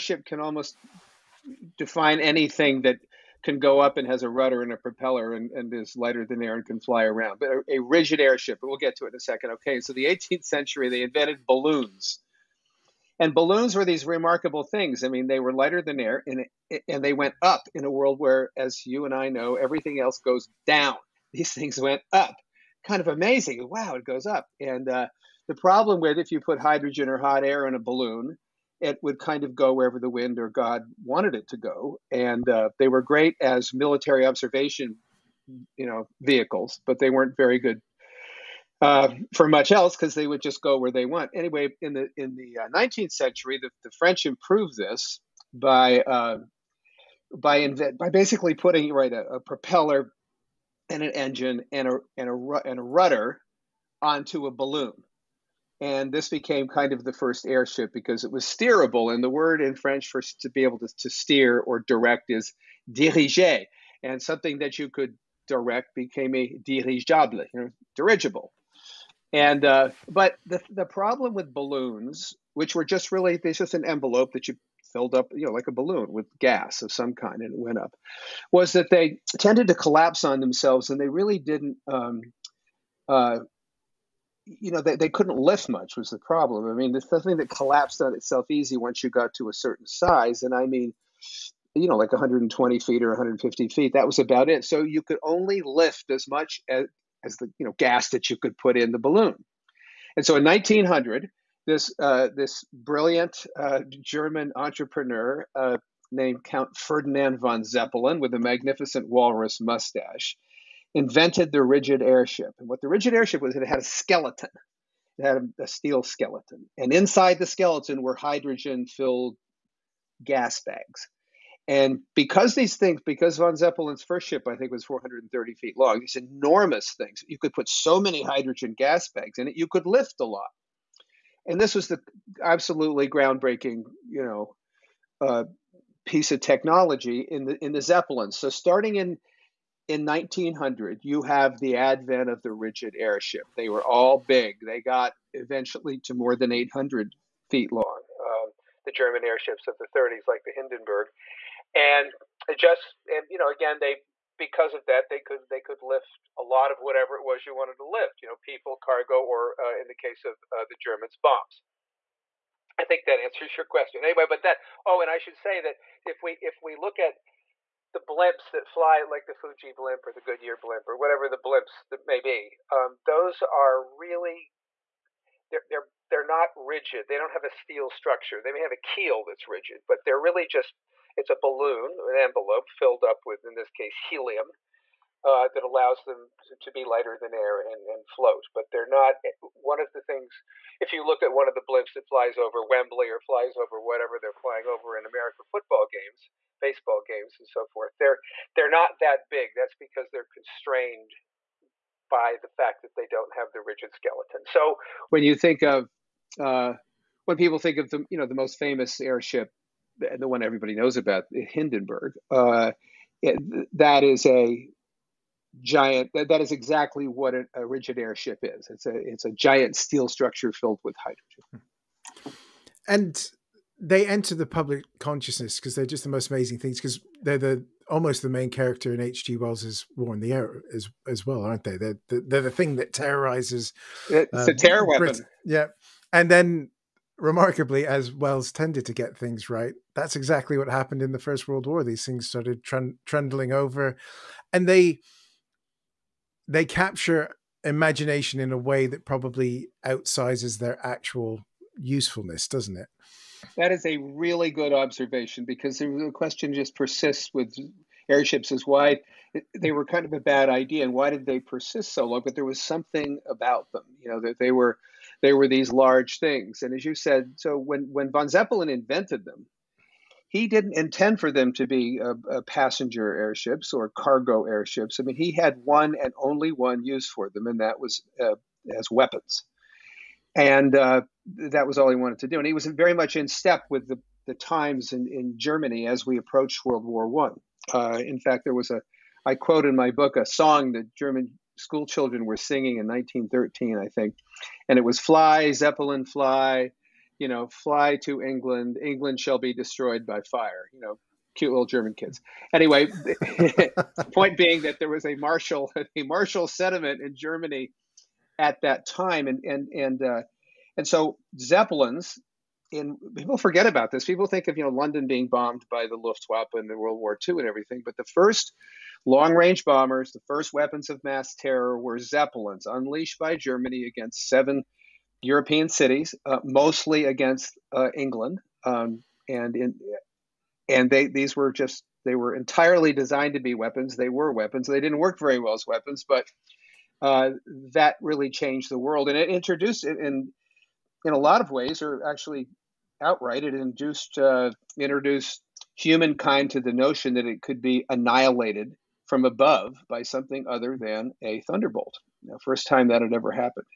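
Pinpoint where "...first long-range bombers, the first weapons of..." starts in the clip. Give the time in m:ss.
5:18.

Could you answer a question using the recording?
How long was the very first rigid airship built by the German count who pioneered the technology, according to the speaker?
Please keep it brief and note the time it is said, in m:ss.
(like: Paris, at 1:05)
430 feet, at 2:04.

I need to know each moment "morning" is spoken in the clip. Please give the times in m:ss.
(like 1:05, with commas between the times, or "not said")
not said.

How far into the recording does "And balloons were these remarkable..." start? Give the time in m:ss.
0:13.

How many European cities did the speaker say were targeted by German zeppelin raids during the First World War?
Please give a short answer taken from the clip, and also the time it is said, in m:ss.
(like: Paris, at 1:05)
7, at 5:24.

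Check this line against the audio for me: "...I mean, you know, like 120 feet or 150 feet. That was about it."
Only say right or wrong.
right.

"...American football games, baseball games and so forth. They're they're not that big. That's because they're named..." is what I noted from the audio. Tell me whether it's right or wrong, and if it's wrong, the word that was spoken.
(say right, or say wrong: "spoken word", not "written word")
wrong: "constrained", not "named".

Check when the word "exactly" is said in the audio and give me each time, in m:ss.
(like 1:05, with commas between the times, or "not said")
3:36, 4:00.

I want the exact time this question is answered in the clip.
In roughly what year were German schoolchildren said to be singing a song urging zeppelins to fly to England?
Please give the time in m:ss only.
4:52.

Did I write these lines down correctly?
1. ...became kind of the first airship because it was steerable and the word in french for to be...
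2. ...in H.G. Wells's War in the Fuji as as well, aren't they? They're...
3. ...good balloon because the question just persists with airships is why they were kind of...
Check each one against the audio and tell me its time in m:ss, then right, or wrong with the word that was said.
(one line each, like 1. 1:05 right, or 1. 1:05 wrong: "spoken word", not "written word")
1. 0:56 right
2. 3:48 wrong: "Air", not "Fuji"
3. 4:14 wrong: "observation", not "balloon".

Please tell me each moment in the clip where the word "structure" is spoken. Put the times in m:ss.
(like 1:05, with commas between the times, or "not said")
2:57, 3:40.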